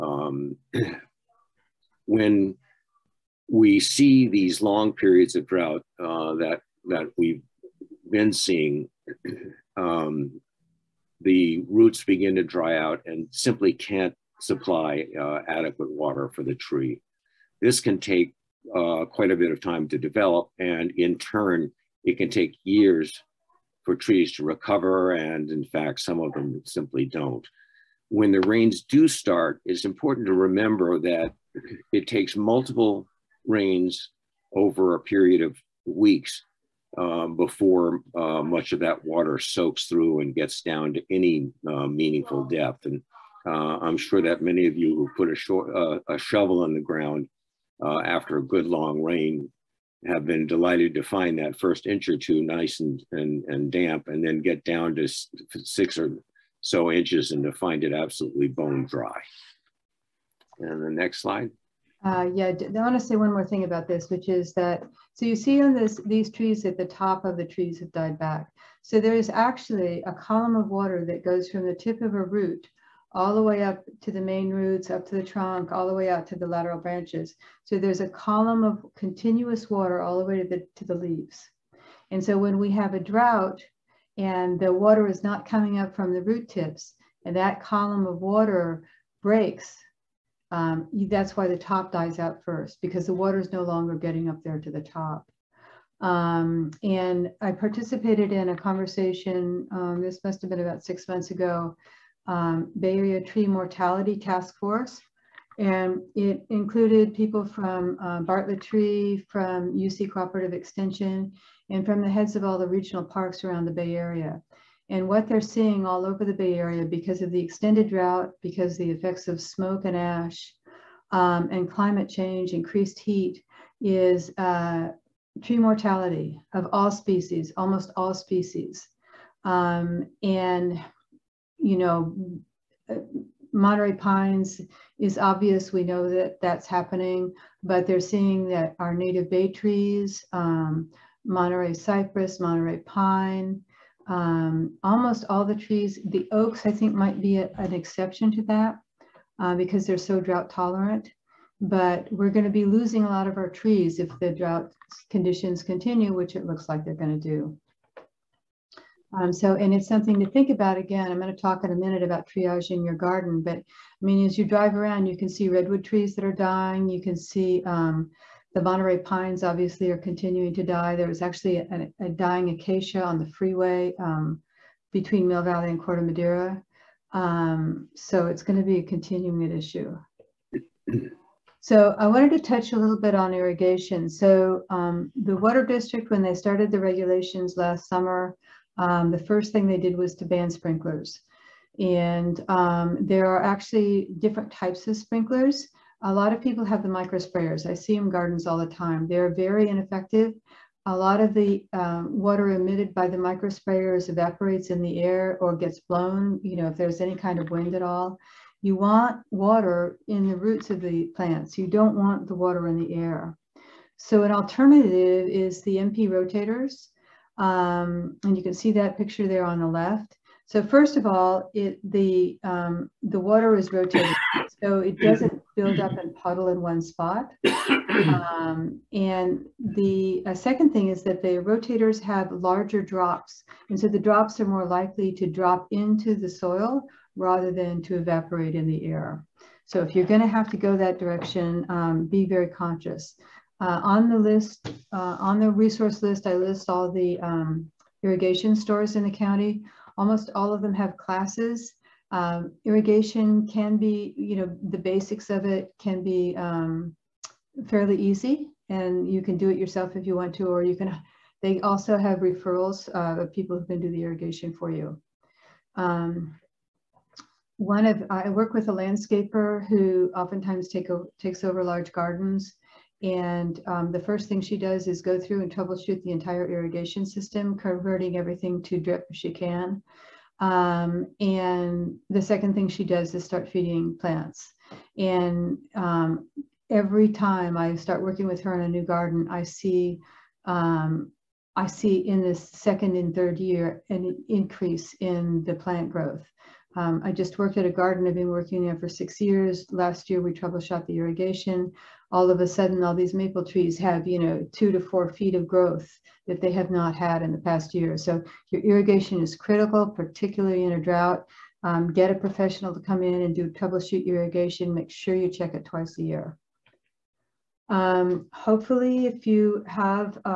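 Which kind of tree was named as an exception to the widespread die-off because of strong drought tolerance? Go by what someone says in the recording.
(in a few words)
Oaks.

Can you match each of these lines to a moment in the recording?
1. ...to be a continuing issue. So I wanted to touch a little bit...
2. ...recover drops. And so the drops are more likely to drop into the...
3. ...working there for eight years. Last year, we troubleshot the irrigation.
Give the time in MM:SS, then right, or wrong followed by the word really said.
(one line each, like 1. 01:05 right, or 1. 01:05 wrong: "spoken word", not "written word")
1. 02:58 right
2. 03:52 wrong: "larger", not "recover"
3. 04:58 wrong: "six", not "eight".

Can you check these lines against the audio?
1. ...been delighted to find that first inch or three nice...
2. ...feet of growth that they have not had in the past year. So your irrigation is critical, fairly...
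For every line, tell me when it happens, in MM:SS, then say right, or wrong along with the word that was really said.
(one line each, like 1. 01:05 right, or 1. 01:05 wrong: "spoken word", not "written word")
1. 00:50 wrong: "two", not "three"
2. 05:05 wrong: "particularly", not "fairly".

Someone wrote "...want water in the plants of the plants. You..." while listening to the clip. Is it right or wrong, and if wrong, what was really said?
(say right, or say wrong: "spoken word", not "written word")
wrong: "roots", not "plants".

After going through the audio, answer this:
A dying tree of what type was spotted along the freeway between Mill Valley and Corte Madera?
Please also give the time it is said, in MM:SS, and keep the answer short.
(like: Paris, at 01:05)
Acacia, at 02:52.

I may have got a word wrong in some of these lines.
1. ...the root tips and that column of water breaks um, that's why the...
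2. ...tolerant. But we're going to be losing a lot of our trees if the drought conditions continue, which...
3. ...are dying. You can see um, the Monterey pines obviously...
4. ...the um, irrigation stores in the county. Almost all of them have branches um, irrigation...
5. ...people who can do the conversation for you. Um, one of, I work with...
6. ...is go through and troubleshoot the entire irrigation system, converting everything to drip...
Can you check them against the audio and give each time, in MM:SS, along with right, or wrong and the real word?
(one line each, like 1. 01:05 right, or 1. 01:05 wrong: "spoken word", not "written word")
1. 01:26 right
2. 02:30 right
3. 02:46 right
4. 04:06 wrong: "classes", not "branches"
5. 04:23 wrong: "irrigation", not "conversation"
6. 04:34 right.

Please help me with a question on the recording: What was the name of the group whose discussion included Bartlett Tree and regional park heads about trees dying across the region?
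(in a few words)
Bay Area Tree Mortality Task Force.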